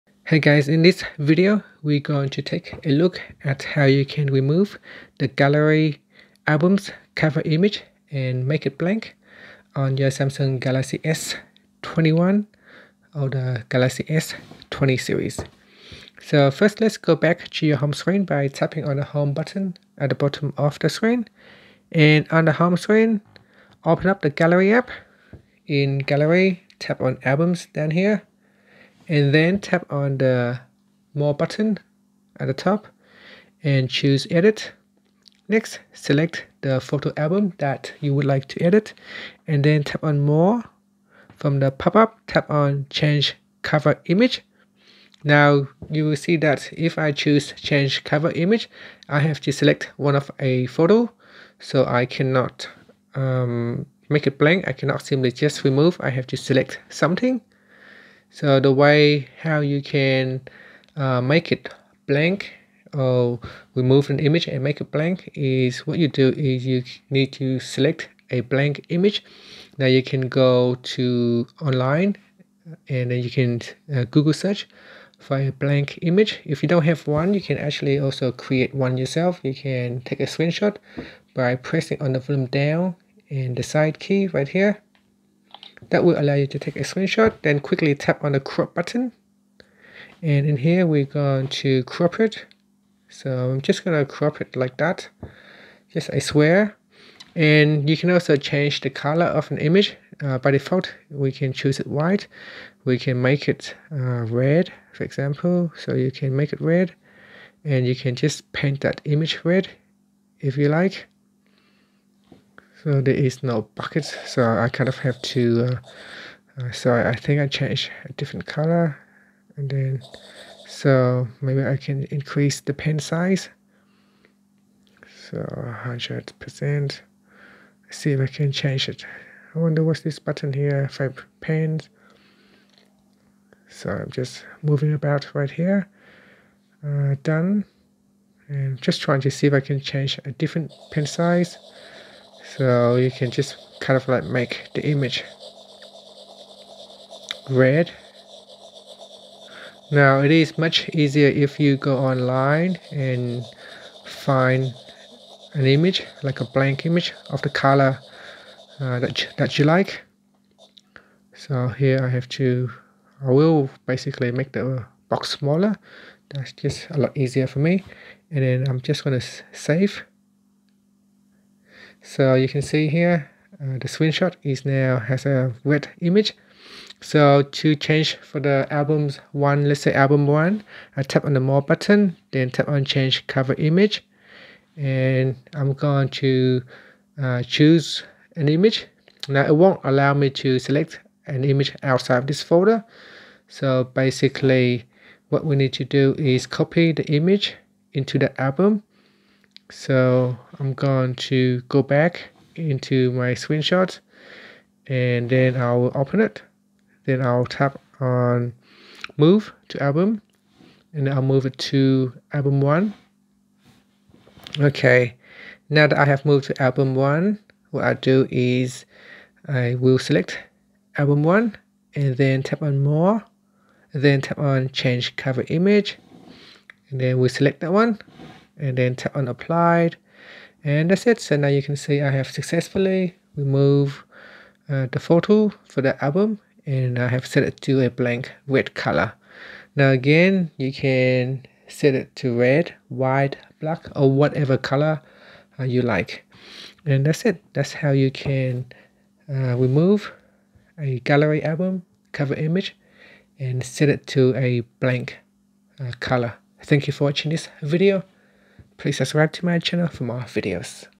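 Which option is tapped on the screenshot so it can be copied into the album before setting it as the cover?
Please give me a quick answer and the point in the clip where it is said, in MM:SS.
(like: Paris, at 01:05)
Move to album, at 03:29.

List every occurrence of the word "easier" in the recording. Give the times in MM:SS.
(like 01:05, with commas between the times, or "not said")
02:30, 02:47.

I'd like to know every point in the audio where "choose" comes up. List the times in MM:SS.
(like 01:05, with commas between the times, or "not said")
00:33, 00:47, 01:41, 03:07.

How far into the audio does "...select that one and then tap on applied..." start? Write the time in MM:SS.
03:47.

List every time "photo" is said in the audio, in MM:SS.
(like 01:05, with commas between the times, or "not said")
00:36, 00:50, 03:54.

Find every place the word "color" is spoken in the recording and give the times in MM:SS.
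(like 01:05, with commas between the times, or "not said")
01:38, 01:58, 02:37, 03:58, 04:04, 04:15.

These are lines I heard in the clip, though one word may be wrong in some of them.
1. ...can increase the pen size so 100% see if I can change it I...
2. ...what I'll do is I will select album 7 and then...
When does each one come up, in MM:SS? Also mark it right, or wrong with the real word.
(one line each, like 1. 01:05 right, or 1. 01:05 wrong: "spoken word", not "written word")
1. 02:01 right
2. 03:37 wrong: "1", not "7".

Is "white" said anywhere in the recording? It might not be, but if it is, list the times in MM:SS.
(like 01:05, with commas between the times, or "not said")
01:41, 04:02.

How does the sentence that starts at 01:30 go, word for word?
And in here, we're going to crop it.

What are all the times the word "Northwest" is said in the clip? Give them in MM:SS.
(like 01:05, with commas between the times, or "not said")
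not said.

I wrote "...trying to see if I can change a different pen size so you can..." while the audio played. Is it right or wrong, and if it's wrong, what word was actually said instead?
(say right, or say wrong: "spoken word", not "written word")
right.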